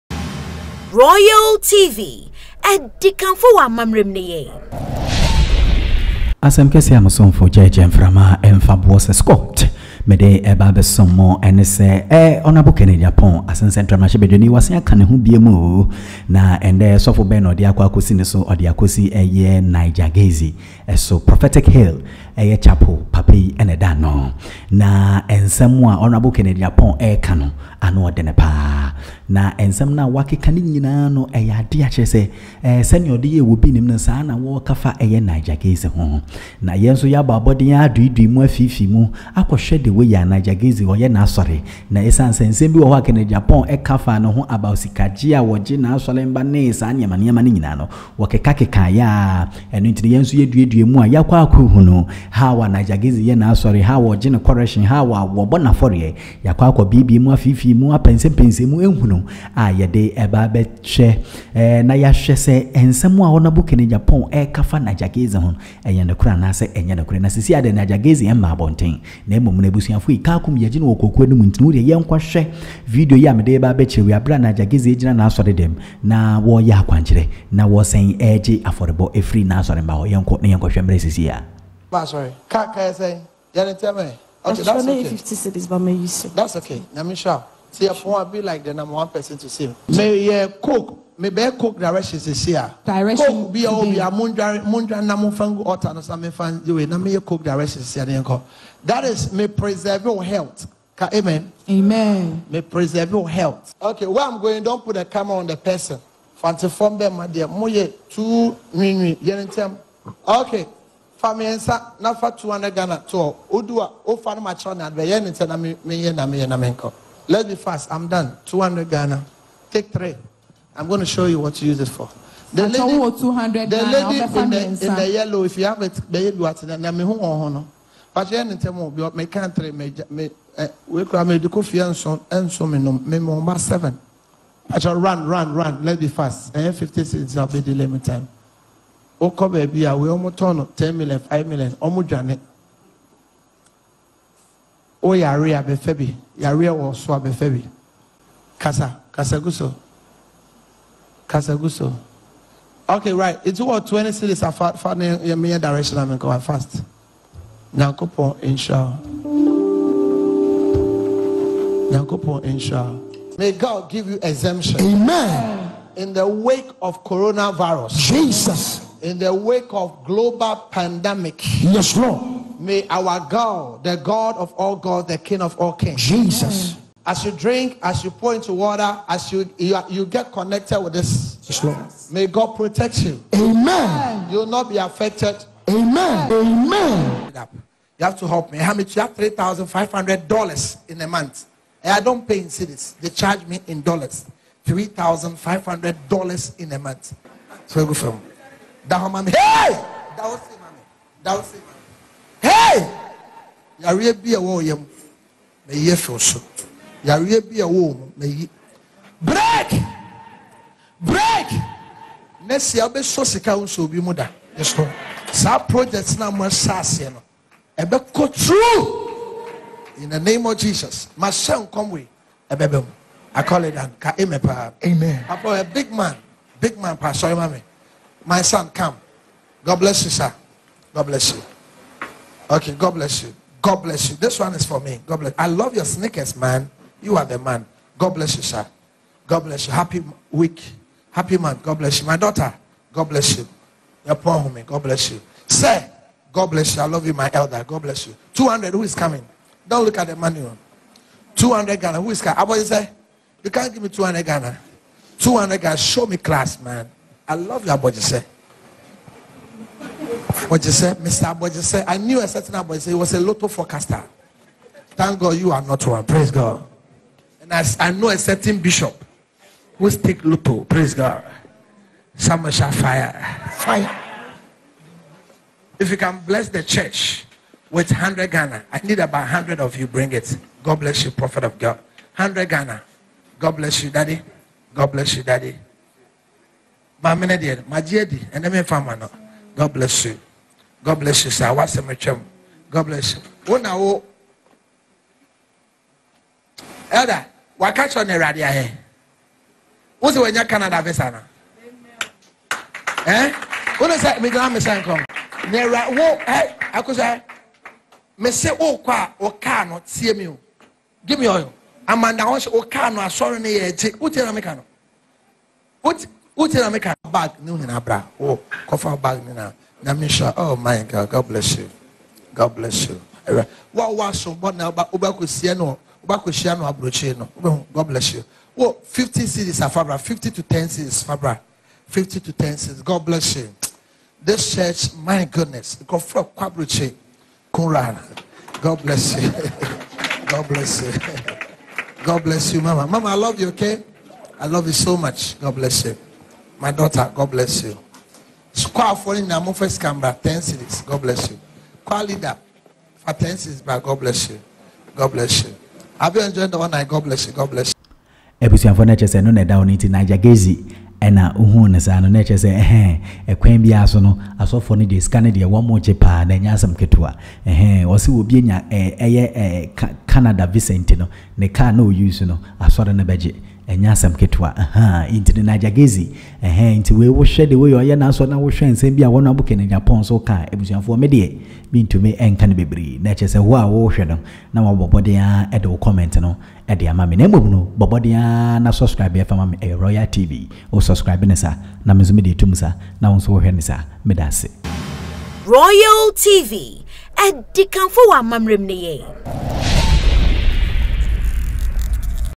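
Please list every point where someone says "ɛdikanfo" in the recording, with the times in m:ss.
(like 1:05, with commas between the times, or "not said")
0:02, 6:37.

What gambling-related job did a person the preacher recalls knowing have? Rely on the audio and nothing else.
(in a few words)
lotto forecaster.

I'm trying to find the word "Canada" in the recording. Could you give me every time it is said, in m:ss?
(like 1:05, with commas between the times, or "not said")
5:00, 6:10.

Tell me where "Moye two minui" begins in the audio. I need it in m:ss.
1:47.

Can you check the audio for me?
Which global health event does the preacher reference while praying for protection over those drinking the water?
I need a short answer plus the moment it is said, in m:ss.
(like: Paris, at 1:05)
coronavirus, at 2:47.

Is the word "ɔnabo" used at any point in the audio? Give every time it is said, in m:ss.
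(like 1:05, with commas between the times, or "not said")
0:12, 0:26, 1:03.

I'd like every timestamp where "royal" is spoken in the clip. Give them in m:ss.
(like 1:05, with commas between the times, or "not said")
0:00, 6:29, 6:35.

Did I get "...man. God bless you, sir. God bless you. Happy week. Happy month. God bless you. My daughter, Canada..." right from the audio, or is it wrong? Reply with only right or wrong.
wrong.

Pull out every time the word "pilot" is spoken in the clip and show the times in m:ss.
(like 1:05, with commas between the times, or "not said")
not said.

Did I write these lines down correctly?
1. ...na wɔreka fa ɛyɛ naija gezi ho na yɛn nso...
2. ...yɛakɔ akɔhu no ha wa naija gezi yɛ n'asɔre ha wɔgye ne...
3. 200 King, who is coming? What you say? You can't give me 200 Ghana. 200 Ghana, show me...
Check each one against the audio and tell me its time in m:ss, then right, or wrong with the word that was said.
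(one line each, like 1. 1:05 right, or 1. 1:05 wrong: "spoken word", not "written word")
1. 0:34 right
2. 0:51 right
3. 4:11 wrong: "Ghana", not "King".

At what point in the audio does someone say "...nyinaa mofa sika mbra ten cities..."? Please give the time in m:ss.
5:49.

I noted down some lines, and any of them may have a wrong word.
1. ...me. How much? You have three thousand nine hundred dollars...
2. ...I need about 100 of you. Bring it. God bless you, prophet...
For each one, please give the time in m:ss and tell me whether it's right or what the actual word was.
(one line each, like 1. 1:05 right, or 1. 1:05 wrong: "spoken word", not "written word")
1. 3:08 wrong: "five", not "nine"
2. 4:38 right.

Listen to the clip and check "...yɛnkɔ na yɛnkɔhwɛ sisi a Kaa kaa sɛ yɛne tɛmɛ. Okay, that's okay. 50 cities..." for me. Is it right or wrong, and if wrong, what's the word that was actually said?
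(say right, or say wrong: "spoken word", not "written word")
right.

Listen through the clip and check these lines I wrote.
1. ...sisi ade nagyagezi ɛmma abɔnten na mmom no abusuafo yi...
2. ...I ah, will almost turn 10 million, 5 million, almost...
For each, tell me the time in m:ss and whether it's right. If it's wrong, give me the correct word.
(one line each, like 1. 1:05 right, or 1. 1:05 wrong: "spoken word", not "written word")
1. 1:07 right
2. 2:19 right.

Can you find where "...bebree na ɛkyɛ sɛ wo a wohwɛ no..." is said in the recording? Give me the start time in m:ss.
6:22.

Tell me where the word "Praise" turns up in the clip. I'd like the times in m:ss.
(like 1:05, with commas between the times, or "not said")
4:26, 4:30.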